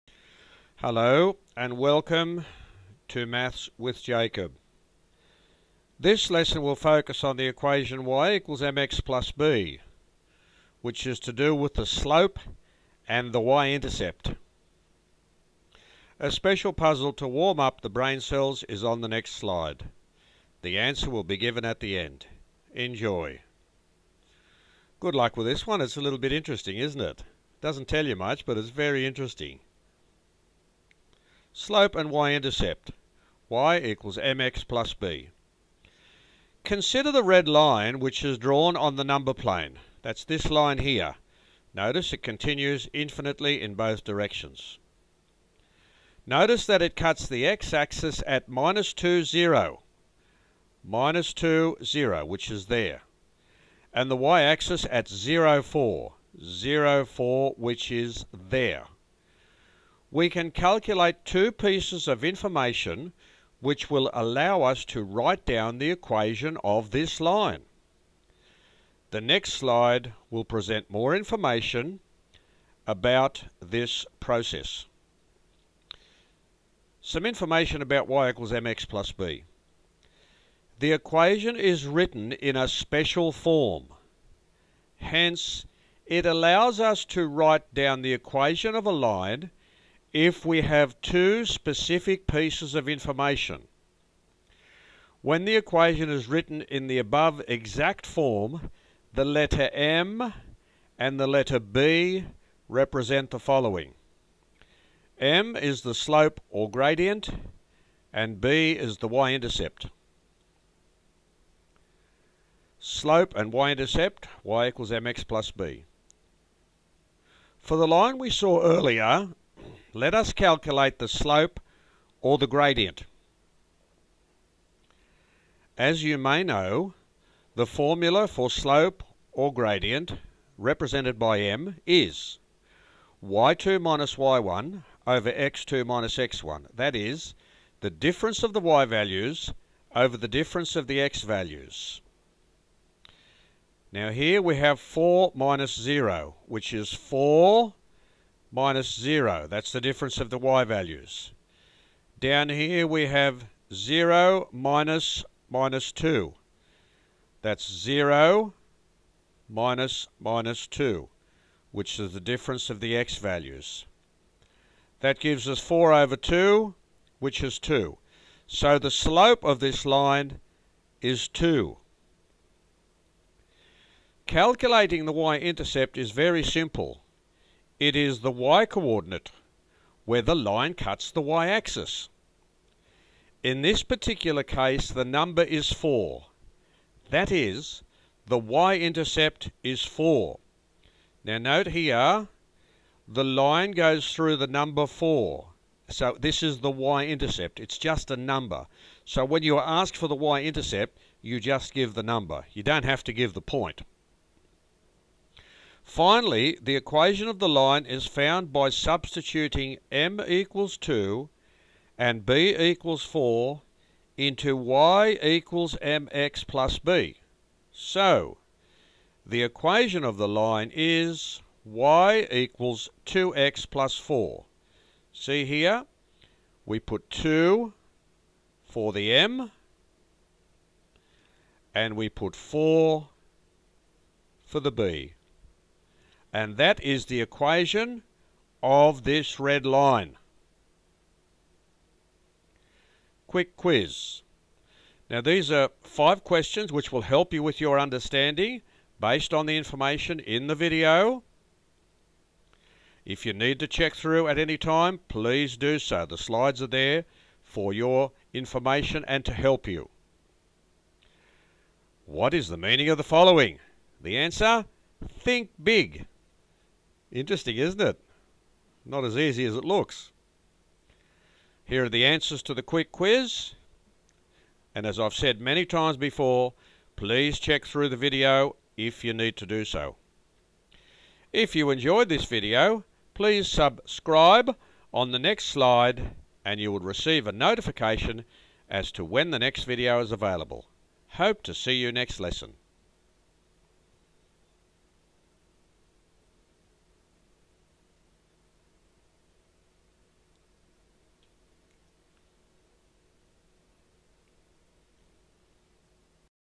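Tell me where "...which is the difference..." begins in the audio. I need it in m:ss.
2:41.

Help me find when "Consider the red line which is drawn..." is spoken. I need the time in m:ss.
0:36.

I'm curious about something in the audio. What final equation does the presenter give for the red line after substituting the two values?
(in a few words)
y = 2x + 4.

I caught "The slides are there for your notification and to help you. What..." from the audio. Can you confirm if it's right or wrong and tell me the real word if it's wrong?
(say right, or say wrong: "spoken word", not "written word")
wrong: "information", not "notification".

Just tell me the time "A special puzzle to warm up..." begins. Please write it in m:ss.
0:16.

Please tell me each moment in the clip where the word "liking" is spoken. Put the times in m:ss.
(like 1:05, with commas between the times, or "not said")
not said.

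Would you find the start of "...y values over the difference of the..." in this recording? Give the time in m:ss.
2:18.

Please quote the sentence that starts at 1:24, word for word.
Hence, it allows us to write down the equation of a line if we have two specific pieces of information.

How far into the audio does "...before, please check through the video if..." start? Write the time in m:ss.
4:35.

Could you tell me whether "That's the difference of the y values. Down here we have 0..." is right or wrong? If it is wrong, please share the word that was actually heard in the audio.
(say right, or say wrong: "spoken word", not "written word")
right.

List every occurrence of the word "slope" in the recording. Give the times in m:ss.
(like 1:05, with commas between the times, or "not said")
0:11, 0:31, 1:45, 1:52, 2:01, 2:08, 2:48.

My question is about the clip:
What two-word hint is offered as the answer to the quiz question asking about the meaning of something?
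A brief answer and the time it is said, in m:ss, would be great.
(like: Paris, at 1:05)
think big, at 4:25.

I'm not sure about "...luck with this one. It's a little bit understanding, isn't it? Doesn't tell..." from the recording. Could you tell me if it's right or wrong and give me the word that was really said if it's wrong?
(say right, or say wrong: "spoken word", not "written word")
wrong: "interesting", not "understanding".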